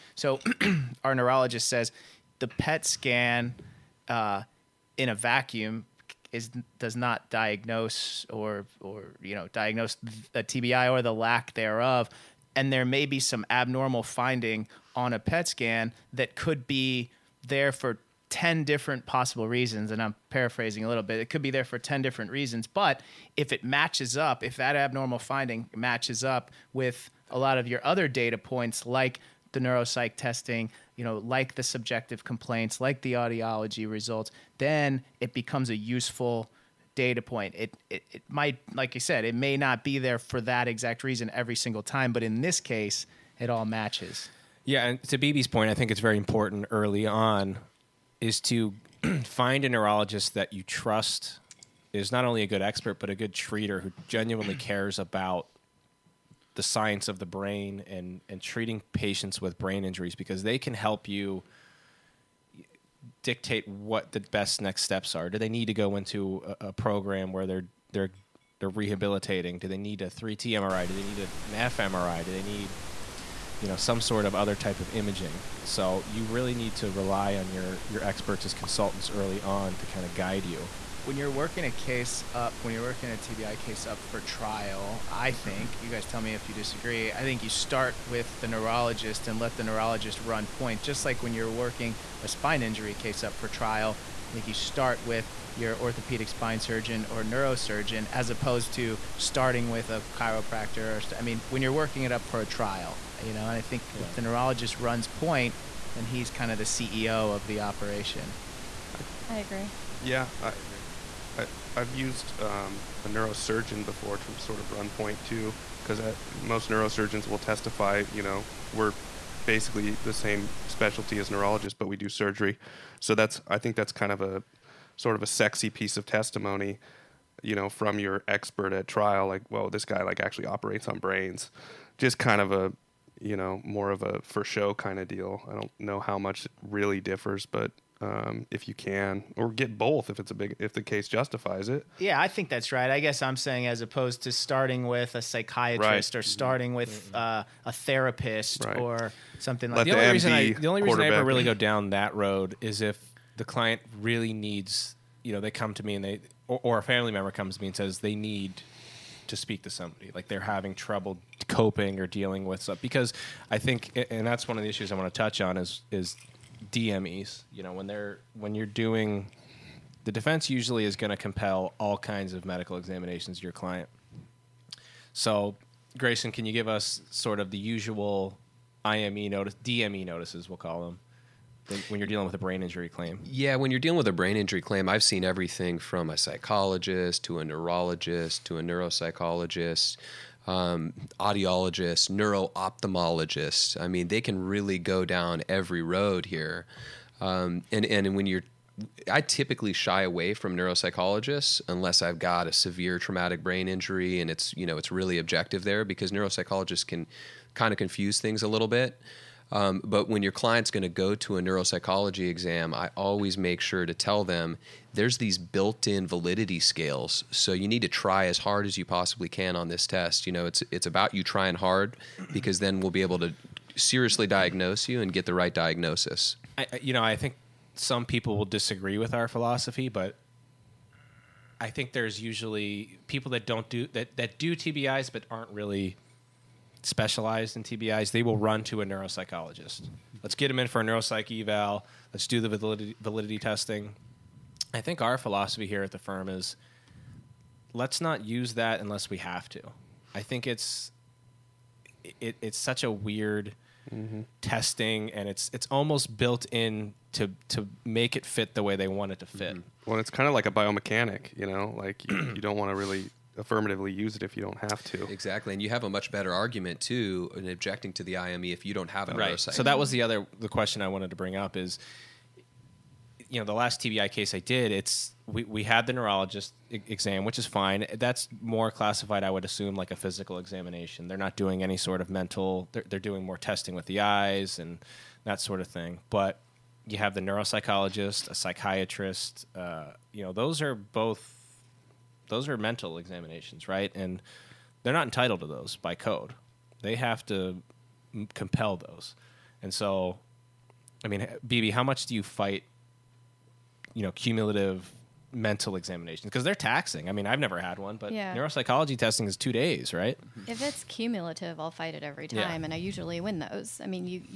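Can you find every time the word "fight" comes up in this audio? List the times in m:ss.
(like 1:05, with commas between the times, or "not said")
5:02, 5:11.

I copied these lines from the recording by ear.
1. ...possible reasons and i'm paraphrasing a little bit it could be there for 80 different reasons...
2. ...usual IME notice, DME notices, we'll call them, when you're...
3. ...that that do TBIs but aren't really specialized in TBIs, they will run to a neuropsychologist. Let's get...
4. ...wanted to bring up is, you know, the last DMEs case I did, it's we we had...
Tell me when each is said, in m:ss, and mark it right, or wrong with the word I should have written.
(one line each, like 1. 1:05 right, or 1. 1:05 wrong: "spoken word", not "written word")
1. 0:19 wrong: "10", not "80"
2. 2:57 right
3. 3:53 right
4. 4:30 wrong: "TBI", not "DMEs".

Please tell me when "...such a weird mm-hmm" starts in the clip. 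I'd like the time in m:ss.
4:12.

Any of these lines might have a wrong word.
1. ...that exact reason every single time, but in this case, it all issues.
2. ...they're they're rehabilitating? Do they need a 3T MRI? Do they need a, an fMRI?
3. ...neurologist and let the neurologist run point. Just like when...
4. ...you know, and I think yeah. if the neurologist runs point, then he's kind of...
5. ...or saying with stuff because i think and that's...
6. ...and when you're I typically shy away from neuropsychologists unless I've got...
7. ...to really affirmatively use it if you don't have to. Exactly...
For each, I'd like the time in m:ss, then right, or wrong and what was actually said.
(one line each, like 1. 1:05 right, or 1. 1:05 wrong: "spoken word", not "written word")
1. 0:40 wrong: "matches", not "issues"
2. 1:07 right
3. 1:28 right
4. 1:43 right
5. 2:41 wrong: "dealing", not "saying"
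6. 3:17 right
7. 4:22 right.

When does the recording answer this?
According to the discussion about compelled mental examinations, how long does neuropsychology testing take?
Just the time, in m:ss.
5:09.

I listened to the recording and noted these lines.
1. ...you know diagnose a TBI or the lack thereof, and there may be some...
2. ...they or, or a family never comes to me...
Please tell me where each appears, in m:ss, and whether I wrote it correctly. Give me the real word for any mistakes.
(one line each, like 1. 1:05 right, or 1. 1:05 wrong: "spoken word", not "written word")
1. 0:09 right
2. 2:36 wrong: "member", not "never".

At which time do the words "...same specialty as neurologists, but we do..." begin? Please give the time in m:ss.
2:00.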